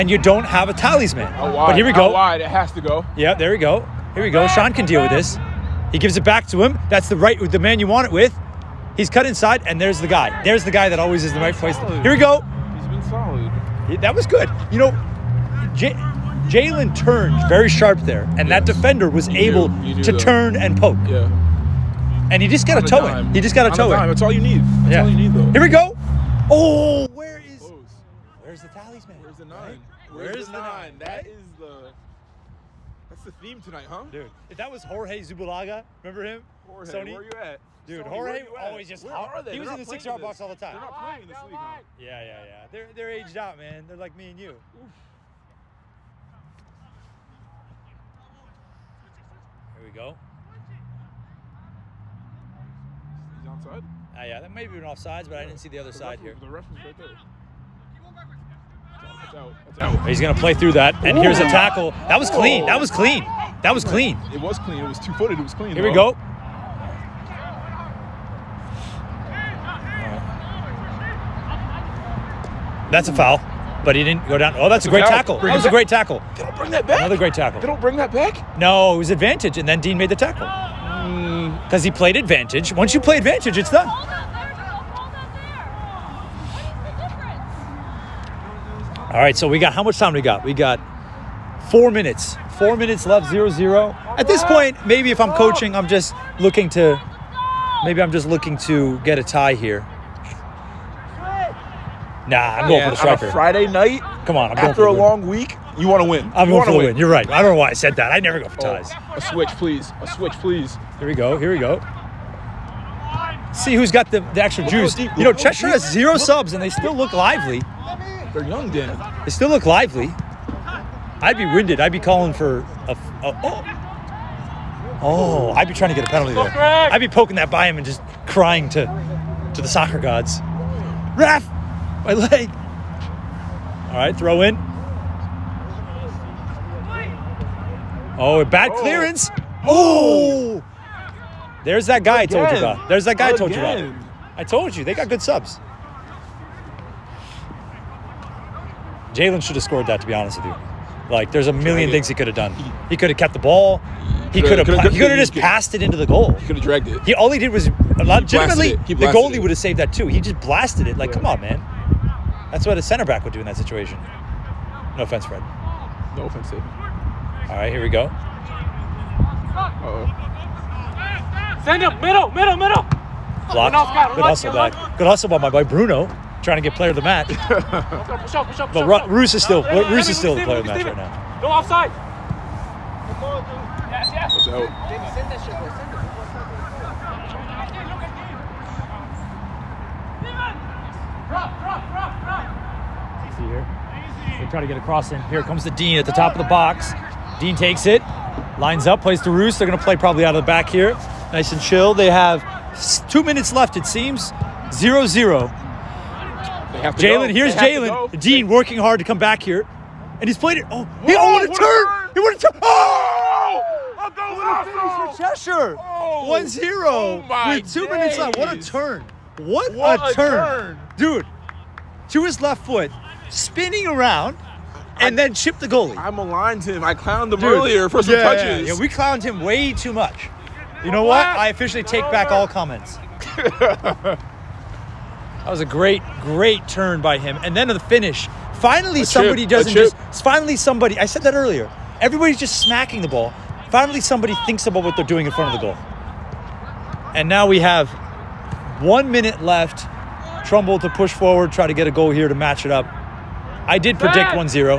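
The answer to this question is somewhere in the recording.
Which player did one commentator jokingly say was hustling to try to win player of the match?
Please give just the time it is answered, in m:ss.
2:55.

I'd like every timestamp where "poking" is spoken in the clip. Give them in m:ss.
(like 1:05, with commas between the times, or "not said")
2:07.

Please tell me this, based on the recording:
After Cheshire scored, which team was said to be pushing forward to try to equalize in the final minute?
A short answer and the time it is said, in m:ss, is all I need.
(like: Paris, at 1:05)
Trumbull, at 4:10.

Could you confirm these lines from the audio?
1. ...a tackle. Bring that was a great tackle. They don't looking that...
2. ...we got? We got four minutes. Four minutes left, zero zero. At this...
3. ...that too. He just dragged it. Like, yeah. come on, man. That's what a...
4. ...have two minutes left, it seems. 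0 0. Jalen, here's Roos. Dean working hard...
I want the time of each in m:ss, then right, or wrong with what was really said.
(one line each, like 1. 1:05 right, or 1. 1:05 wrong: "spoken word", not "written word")
1. 1:15 wrong: "bring", not "looking"
2. 1:30 right
3. 2:39 wrong: "blasted", not "dragged"
4. 3:22 wrong: "Jalen", not "Roos".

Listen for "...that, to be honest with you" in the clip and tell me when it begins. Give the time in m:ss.
2:29.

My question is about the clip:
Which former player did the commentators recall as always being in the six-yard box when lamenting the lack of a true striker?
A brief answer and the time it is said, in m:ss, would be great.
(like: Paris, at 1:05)
Jorge Zubalaga, at 0:34.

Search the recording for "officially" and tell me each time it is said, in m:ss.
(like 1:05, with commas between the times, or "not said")
3:51.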